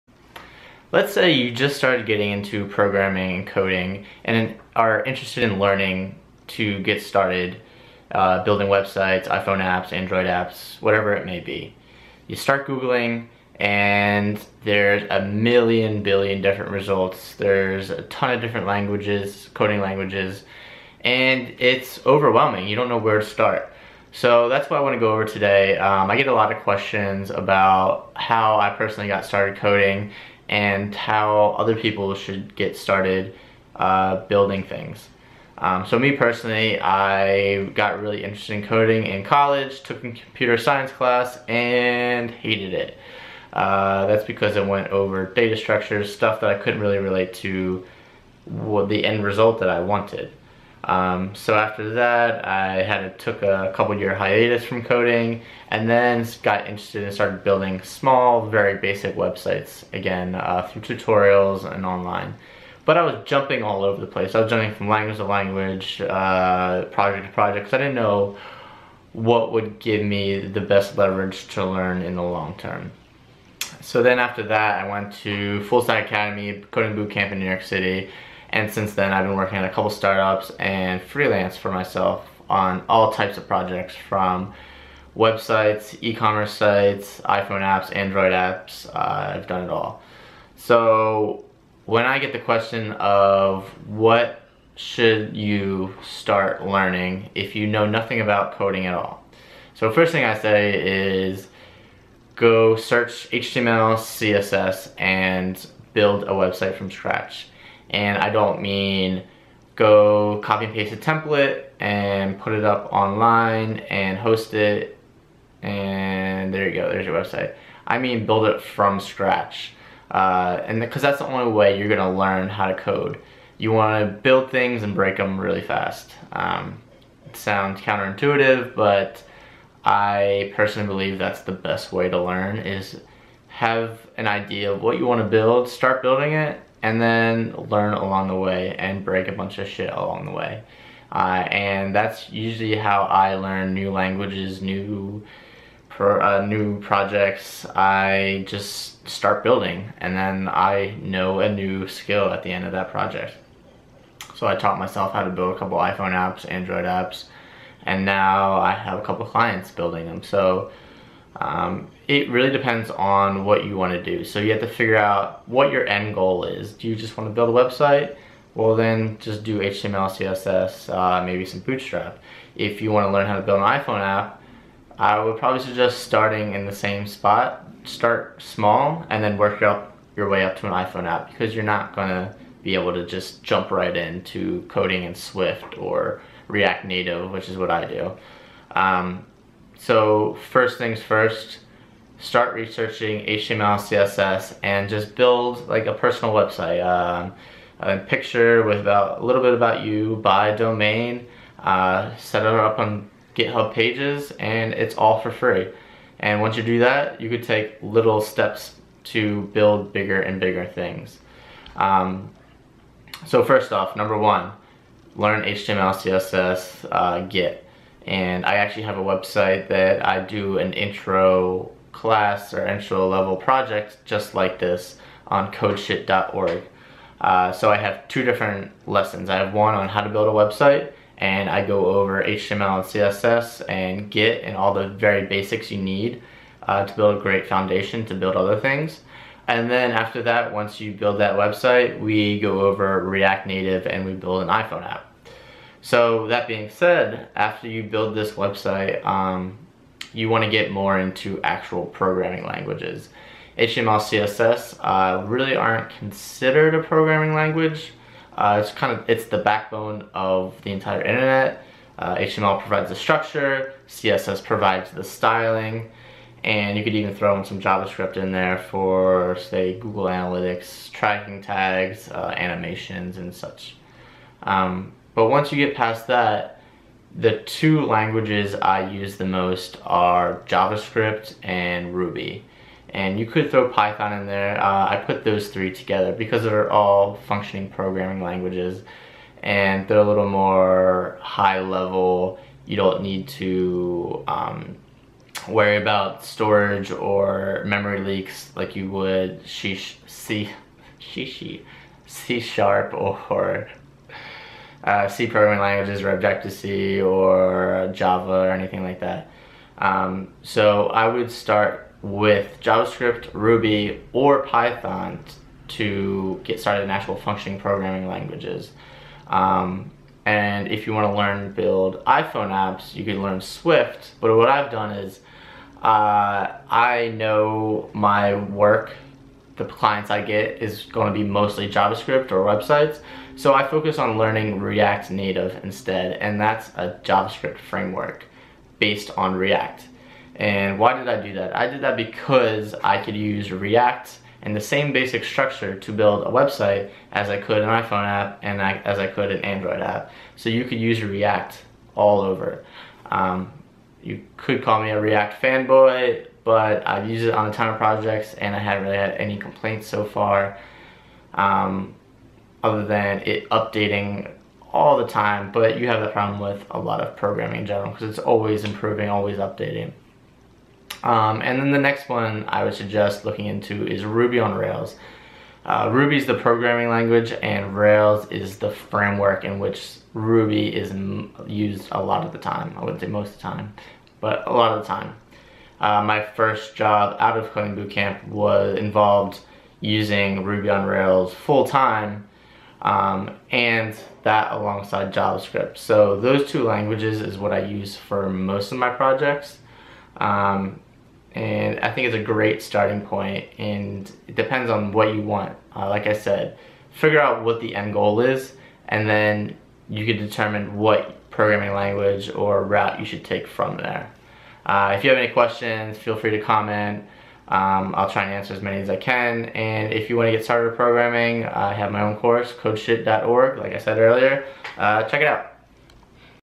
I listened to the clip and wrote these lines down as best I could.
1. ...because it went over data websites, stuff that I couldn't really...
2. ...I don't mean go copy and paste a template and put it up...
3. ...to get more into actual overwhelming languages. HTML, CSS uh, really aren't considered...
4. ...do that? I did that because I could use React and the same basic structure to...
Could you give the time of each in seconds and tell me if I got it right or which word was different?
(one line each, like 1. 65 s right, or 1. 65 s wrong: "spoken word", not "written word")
1. 44 s wrong: "structures", not "websites"
2. 108 s right
3. 250 s wrong: "programming", not "overwhelming"
4. 341 s right.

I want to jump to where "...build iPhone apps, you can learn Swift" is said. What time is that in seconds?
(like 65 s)
321 s.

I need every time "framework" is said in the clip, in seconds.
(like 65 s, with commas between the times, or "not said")
337 s, 378 s.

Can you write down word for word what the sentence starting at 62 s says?
But I was jumping all over the place.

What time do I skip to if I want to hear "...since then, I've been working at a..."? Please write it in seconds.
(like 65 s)
78 s.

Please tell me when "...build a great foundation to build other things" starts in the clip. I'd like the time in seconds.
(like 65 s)
236 s.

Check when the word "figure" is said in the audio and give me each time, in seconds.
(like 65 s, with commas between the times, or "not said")
164 s, 406 s.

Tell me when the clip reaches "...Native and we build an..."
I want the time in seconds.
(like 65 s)
243 s.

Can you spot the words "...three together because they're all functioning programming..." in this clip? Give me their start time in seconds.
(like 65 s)
285 s.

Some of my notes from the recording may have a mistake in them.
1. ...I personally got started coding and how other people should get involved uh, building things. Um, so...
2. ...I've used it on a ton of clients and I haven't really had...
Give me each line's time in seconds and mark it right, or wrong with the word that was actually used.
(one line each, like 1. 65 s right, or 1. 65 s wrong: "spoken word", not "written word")
1. 28 s wrong: "started", not "involved"
2. 356 s wrong: "projects", not "clients".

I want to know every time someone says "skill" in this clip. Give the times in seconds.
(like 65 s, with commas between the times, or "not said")
151 s.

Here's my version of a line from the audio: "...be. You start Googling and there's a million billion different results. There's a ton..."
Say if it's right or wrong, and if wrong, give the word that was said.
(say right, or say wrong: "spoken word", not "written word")
right.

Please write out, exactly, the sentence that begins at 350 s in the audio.
So you could use React all over.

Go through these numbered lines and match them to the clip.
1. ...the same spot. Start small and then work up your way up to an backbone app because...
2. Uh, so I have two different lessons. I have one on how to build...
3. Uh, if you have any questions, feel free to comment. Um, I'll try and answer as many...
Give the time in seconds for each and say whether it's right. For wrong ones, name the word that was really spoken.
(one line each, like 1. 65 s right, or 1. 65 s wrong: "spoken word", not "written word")
1. 176 s wrong: "iPhone", not "backbone"
2. 227 s right
3. 414 s right.